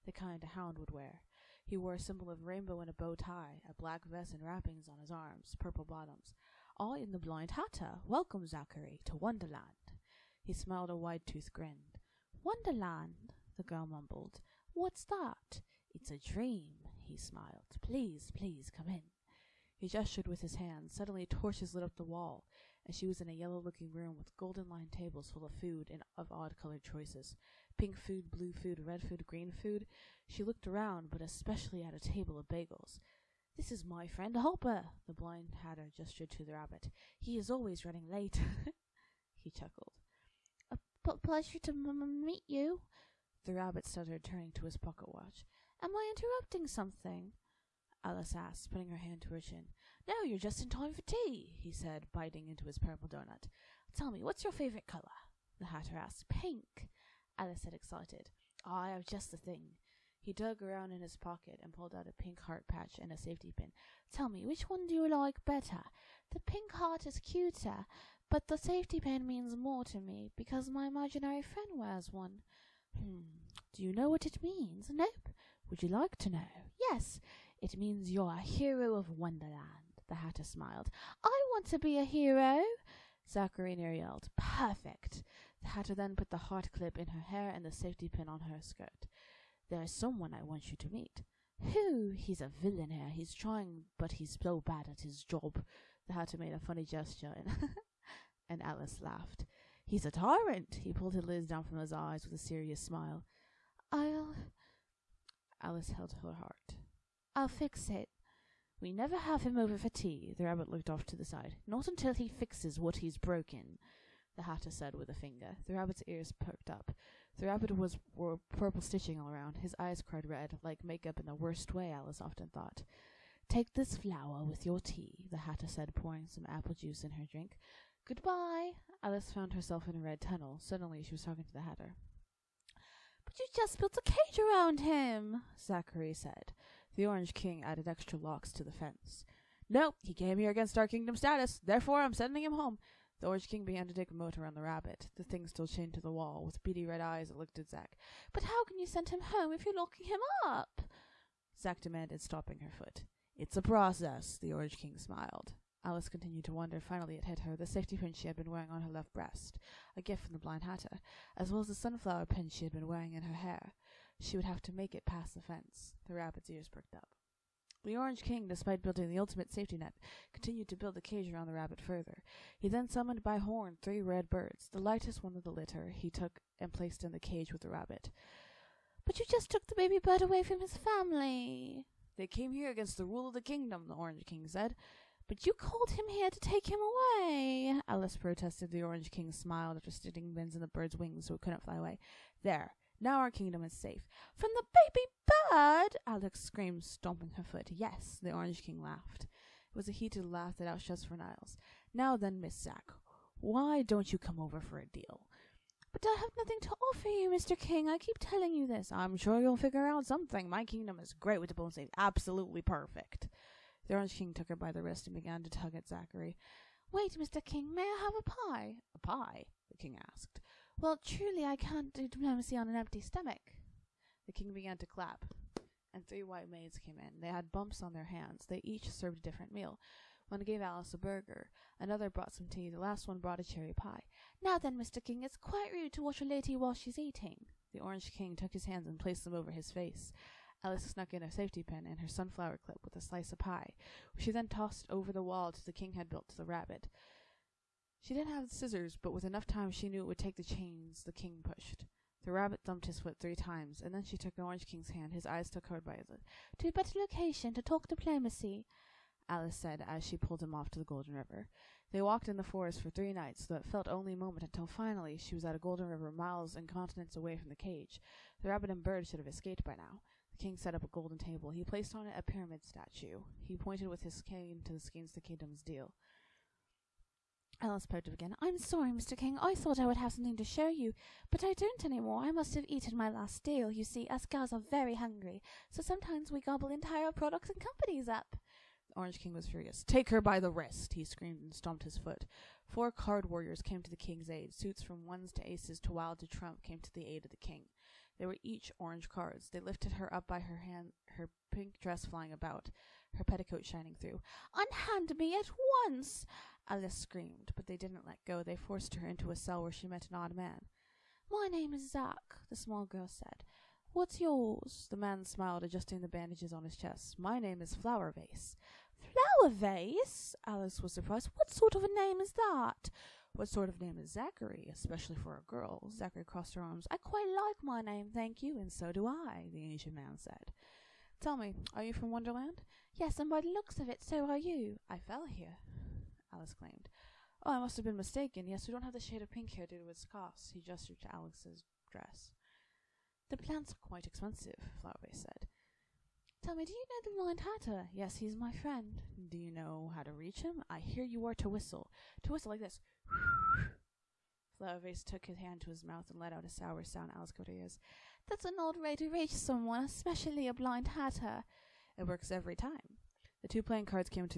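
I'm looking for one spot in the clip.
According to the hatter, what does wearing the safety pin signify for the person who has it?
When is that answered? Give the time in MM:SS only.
01:18.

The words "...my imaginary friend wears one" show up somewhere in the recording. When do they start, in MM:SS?
01:10.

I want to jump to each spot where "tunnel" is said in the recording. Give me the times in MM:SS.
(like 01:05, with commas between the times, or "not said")
02:10.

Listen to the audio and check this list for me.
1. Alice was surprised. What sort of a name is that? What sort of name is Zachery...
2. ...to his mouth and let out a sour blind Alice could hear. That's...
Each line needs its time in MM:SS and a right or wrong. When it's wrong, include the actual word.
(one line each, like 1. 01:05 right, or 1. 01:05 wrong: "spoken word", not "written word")
1. 05:20 right
2. 05:55 wrong: "sound", not "blind".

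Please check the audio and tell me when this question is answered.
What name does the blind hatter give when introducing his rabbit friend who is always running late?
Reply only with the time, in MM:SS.
00:34.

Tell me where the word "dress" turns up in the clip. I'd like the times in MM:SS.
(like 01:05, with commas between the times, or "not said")
05:01, 05:41.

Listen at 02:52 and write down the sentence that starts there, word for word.
He then summoned by horn three red birds.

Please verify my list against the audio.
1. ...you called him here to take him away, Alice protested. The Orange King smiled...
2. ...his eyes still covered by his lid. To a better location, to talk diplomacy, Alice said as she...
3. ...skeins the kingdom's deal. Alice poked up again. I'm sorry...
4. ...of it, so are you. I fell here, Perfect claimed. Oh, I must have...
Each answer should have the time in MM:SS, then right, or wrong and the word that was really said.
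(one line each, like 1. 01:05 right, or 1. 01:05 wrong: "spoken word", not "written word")
1. 03:05 right
2. 04:15 right
3. 04:34 right
4. 05:33 wrong: "Alice", not "Perfect".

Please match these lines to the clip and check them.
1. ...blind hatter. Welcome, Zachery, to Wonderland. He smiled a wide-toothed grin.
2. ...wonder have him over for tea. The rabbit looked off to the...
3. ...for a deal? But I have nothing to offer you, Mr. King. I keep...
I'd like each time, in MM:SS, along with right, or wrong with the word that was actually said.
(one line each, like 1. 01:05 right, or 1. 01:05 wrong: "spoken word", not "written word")
1. 00:07 right
2. 01:48 wrong: "never", not "wonder"
3. 03:24 right.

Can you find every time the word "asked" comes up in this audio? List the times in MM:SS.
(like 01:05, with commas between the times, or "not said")
00:48, 00:55, 03:40.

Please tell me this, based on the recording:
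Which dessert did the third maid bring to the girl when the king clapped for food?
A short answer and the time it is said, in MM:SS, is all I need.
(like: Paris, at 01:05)
Cherry pie, at 03:53.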